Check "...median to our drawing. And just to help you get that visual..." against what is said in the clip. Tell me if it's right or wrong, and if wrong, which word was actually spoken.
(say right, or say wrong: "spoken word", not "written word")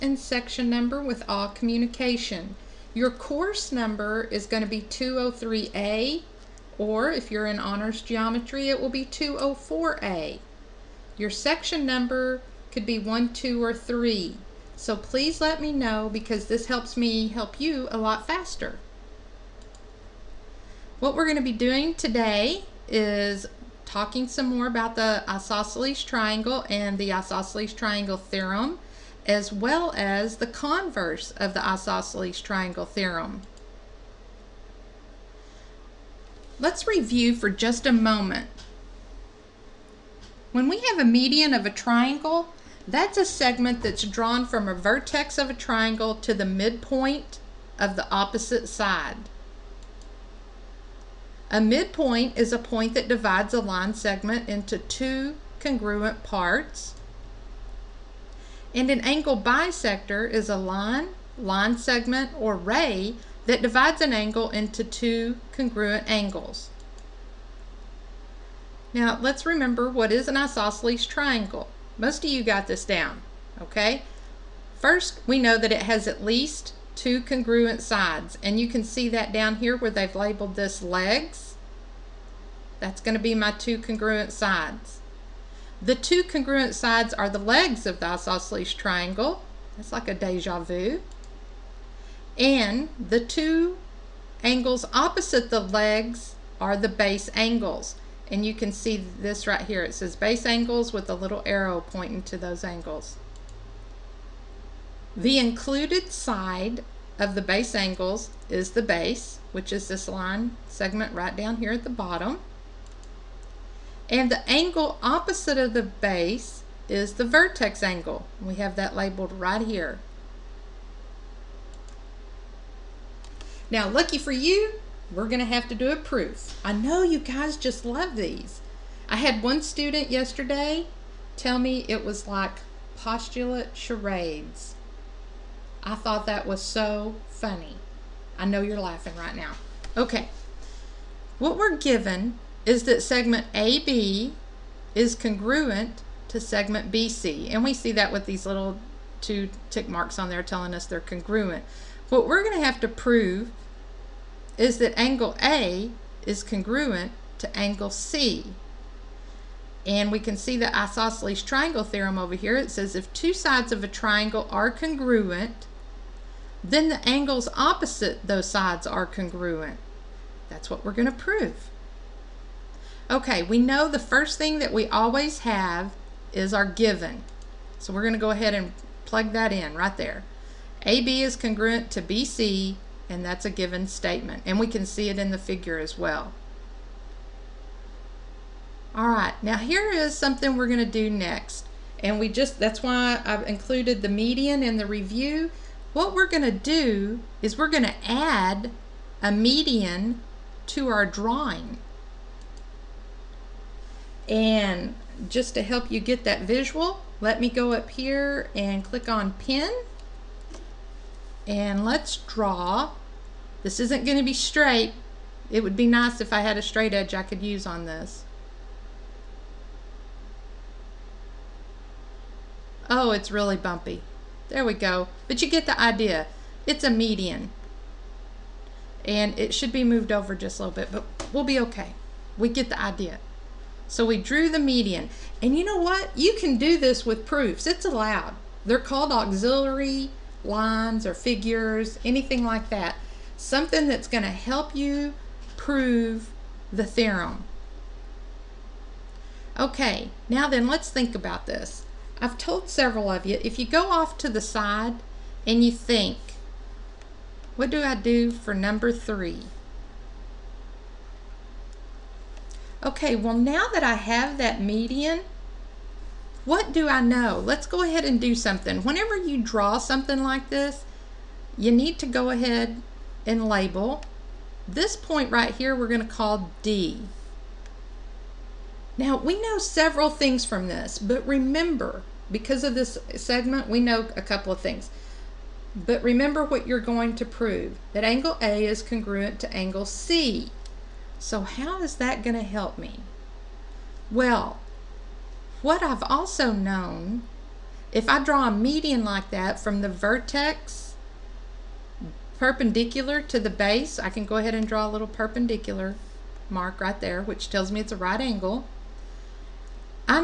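right.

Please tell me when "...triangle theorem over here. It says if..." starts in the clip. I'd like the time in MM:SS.
02:41.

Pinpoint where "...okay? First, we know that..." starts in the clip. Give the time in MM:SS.
01:13.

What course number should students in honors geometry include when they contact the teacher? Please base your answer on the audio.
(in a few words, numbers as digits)
204A.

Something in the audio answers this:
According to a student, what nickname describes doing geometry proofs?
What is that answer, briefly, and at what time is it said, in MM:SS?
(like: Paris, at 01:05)
postulate charades, at 02:12.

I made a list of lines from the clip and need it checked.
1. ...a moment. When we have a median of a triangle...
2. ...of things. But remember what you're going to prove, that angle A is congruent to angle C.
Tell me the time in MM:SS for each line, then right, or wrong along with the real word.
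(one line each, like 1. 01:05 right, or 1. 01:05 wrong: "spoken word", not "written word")
1. 00:37 right
2. 04:44 right.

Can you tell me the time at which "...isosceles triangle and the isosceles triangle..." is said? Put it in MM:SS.
00:25.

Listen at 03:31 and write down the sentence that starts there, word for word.
And let's draw this isn't going to be straight.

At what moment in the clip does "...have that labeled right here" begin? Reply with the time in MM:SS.
01:58.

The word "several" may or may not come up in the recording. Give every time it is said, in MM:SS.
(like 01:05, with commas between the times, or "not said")
04:12, 04:39.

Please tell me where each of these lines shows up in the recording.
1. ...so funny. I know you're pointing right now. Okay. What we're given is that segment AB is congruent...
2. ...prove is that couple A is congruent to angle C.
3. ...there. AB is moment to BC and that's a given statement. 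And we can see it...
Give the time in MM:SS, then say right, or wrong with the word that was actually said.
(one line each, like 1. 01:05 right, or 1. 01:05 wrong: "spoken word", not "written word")
1. 02:16 wrong: "laughing", not "pointing"
2. 02:32 wrong: "angle", not "couple"
3. 02:59 wrong: "congruent", not "moment".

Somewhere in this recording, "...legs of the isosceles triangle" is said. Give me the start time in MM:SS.
01:27.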